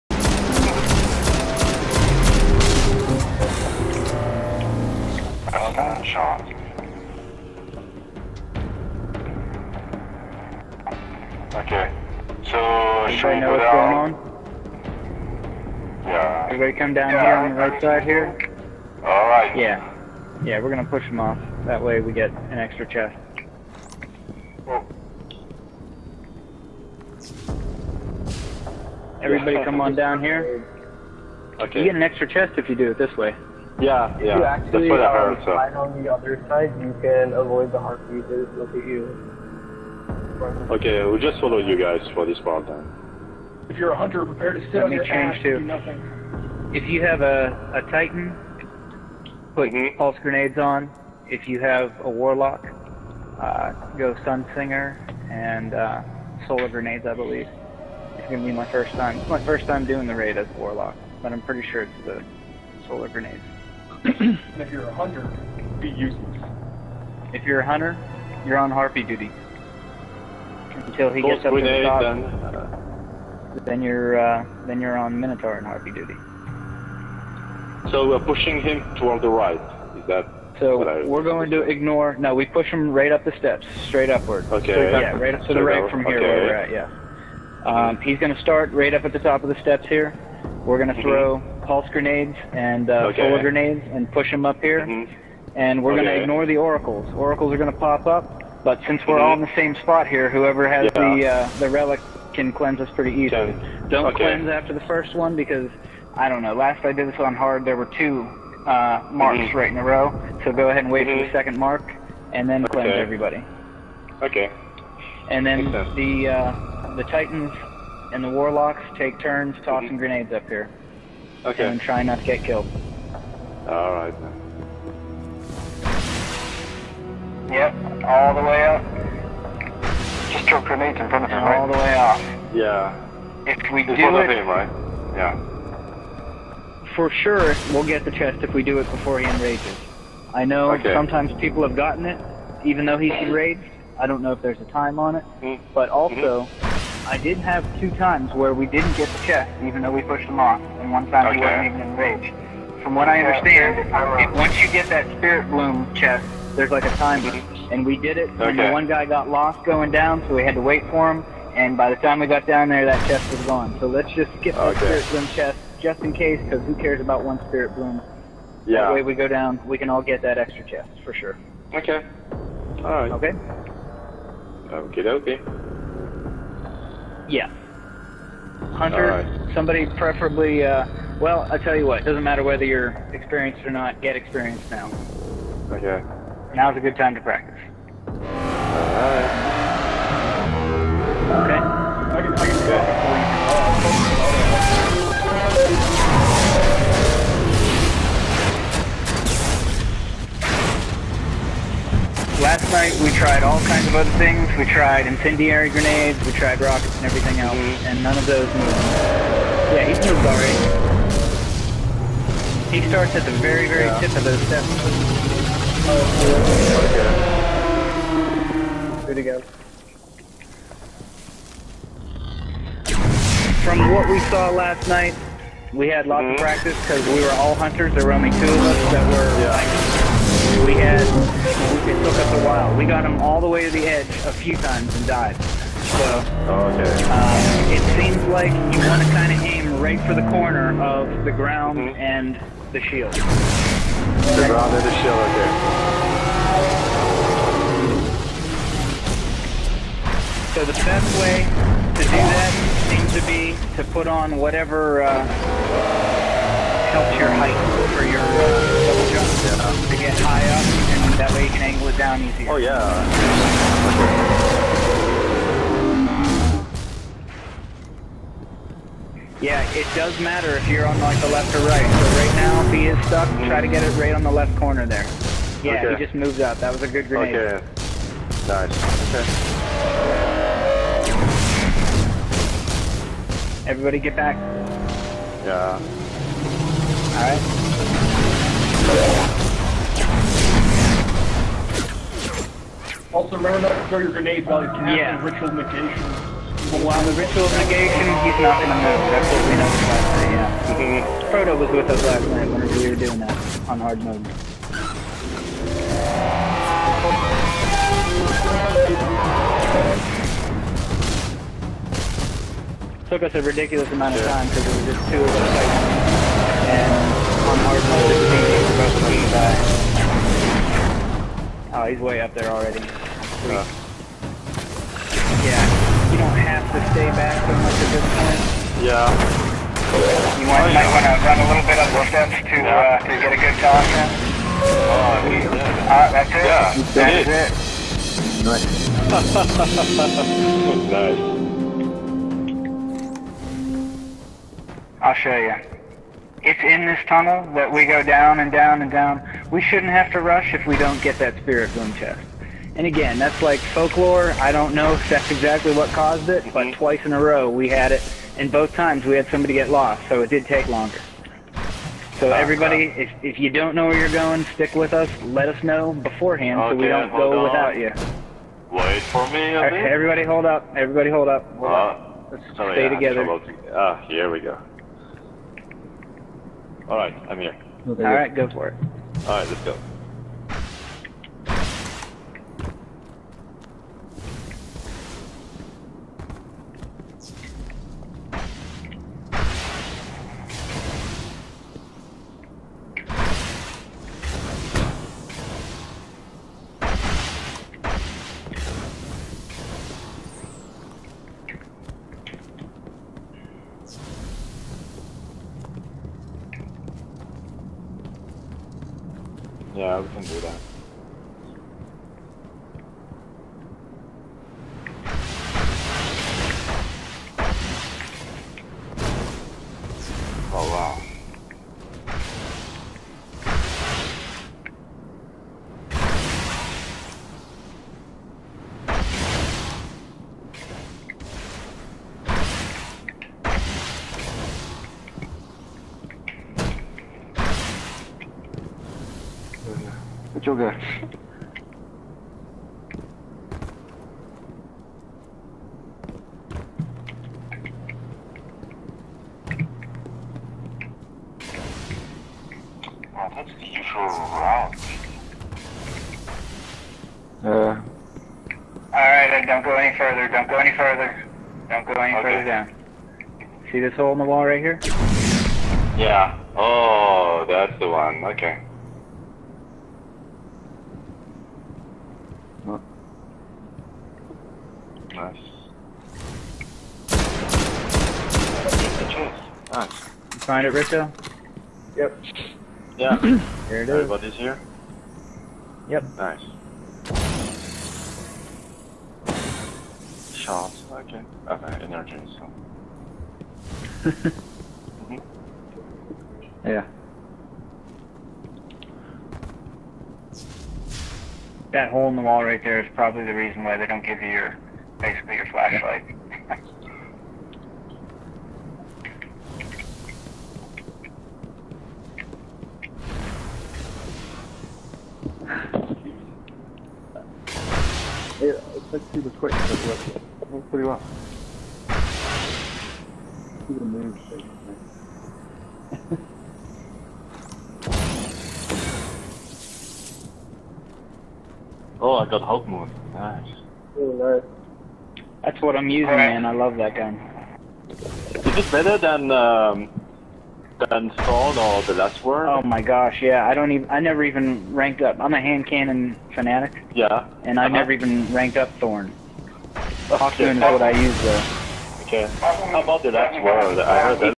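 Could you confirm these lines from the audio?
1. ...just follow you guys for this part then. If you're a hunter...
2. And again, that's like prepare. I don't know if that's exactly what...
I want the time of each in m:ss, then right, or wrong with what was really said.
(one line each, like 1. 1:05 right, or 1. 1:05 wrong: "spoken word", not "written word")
1. 0:41 right
2. 5:52 wrong: "folklore", not "prepare".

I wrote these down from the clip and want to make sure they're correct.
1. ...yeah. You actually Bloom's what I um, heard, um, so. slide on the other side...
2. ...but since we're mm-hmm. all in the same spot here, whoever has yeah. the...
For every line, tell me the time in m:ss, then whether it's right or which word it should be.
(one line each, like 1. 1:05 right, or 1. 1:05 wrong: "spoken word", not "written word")
1. 0:34 wrong: "That", not "Bloom"
2. 1:38 right.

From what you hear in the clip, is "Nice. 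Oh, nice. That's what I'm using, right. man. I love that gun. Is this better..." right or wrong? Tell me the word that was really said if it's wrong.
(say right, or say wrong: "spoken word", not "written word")
right.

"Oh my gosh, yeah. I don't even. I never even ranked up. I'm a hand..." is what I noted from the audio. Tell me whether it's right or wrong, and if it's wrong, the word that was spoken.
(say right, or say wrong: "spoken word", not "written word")
right.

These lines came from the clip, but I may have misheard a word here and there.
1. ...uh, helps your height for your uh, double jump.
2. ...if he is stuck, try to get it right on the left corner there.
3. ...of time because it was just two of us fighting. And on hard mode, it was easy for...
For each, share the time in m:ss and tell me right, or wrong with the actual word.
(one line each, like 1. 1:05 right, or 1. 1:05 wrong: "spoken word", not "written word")
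1. 4:15 right
2. 4:32 right
3. 5:14 right.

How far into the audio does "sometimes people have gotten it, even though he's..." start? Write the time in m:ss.
2:20.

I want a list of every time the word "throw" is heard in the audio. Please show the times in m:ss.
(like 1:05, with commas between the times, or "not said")
1:31, 4:53.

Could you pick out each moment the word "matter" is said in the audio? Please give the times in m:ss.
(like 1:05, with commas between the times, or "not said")
3:02, 4:30.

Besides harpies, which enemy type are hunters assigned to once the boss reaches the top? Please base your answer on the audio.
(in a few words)
Minotaur.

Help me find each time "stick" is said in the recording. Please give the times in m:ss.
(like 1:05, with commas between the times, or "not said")
6:04.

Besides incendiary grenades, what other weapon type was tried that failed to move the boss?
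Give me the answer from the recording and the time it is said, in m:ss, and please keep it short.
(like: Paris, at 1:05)
Rockets, at 3:26.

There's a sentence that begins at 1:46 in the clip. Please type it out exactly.
Last I did this on hard, there were two uh, marks mm-hmm.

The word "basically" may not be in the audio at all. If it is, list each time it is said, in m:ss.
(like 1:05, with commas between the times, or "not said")
8:25.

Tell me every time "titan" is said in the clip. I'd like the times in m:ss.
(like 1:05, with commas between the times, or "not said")
0:47, 1:57.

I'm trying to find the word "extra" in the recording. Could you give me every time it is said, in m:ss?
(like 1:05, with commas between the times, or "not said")
0:22, 0:32, 2:50.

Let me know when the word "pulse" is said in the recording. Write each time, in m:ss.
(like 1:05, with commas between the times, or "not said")
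0:49, 1:31.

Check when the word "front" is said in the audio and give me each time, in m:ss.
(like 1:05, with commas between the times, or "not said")
2:11.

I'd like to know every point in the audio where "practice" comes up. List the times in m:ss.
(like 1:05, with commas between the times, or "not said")
3:07, 3:46.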